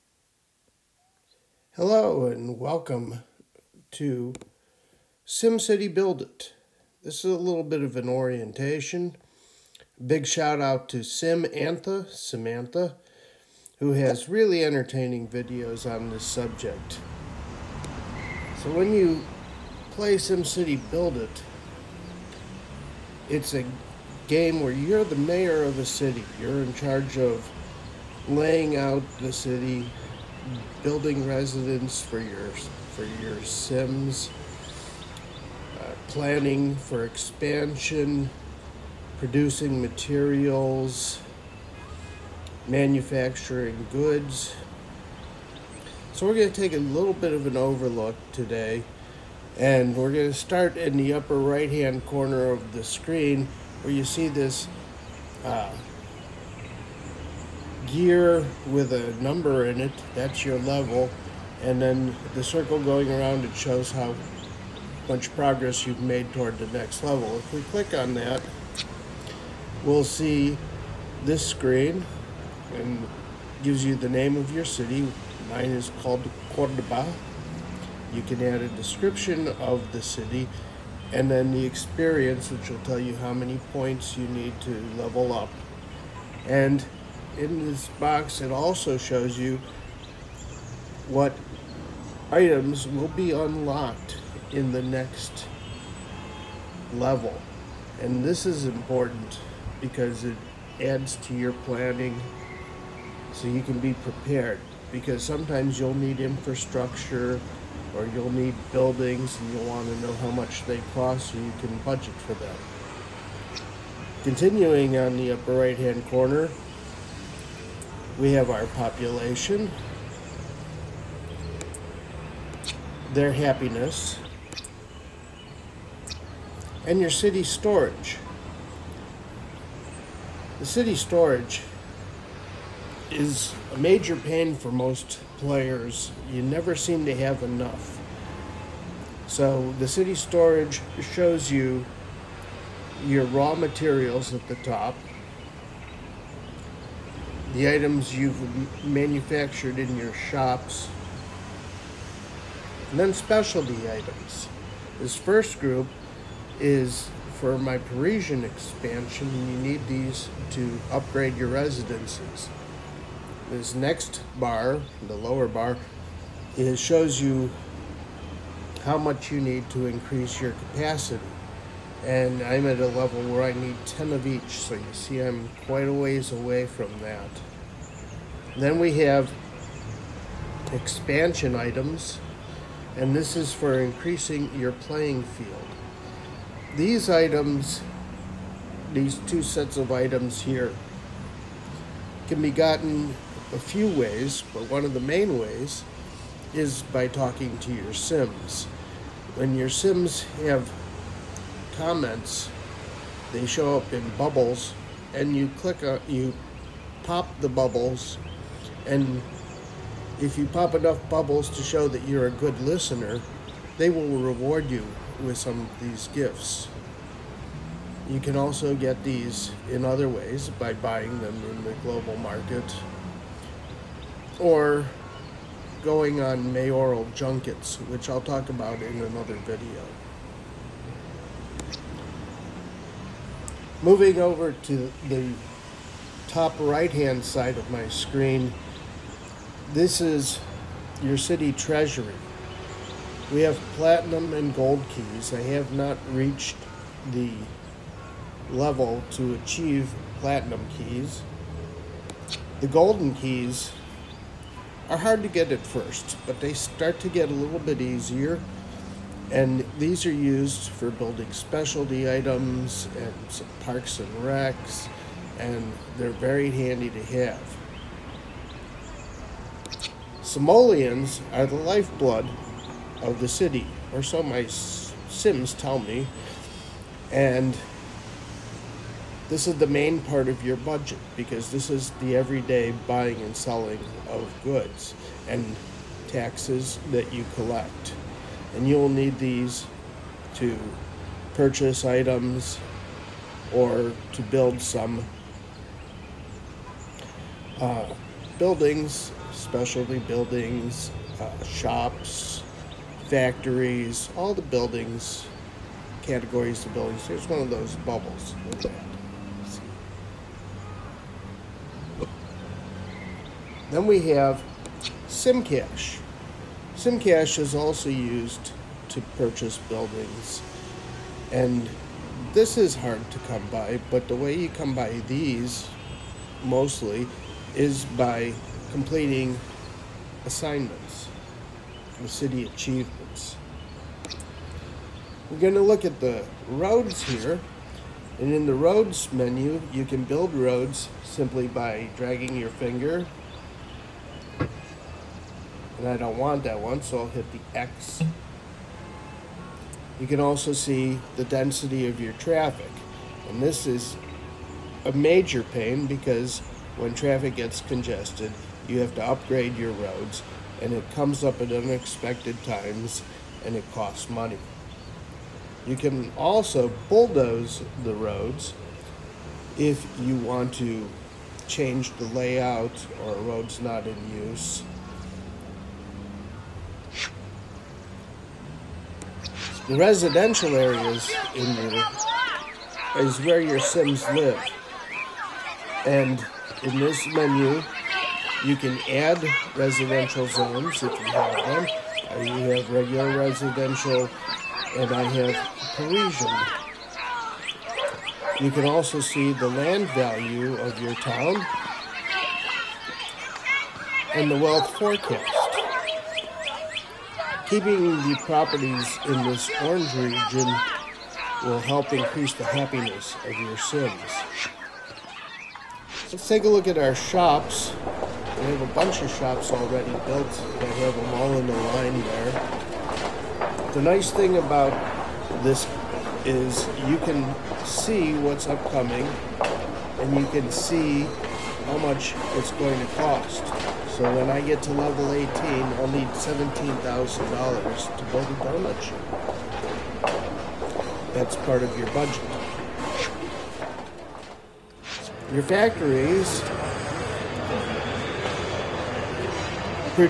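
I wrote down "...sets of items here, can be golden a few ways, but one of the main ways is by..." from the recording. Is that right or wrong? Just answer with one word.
wrong.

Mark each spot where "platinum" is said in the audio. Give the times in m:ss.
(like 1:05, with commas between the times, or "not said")
4:03, 4:10.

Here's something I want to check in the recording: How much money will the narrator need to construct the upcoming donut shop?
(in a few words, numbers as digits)
$17,000.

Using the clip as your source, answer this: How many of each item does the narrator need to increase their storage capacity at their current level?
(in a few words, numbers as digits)
10.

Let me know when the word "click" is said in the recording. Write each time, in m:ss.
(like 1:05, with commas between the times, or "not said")
1:07, 3:25.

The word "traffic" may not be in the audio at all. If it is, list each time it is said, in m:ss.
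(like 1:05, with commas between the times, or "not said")
5:52, 5:56.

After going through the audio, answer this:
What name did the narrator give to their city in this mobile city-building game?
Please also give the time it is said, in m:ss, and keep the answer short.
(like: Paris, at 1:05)
Cordoba, at 1:16.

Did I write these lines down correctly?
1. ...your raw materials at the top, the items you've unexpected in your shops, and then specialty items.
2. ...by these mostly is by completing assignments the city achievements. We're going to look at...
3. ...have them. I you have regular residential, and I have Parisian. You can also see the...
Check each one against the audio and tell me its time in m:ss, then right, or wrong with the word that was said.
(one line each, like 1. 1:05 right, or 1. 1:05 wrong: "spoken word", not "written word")
1. 2:23 wrong: "manufactured", not "unexpected"
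2. 5:24 right
3. 6:31 right.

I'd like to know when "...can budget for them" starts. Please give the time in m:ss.
1:51.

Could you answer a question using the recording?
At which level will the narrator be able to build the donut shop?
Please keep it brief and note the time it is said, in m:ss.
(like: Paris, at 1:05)
18, at 7:14.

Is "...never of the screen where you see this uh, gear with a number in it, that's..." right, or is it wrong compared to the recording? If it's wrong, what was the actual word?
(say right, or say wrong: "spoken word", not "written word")
wrong: "corner", not "never".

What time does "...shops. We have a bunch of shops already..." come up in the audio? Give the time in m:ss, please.
6:56.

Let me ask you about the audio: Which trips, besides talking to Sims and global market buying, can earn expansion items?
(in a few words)
mayoral junkets.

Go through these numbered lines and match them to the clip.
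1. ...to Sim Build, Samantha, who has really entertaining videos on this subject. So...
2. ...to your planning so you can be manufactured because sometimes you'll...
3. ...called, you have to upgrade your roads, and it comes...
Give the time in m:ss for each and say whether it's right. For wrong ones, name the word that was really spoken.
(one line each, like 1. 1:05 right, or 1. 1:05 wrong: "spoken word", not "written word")
1. 0:10 wrong: "Antha", not "Build"
2. 1:41 wrong: "prepared", not "manufactured"
3. 5:57 wrong: "congested", not "called".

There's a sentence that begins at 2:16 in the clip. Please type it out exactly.
You never seem to have enough.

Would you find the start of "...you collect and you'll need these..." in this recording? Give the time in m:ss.
4:47.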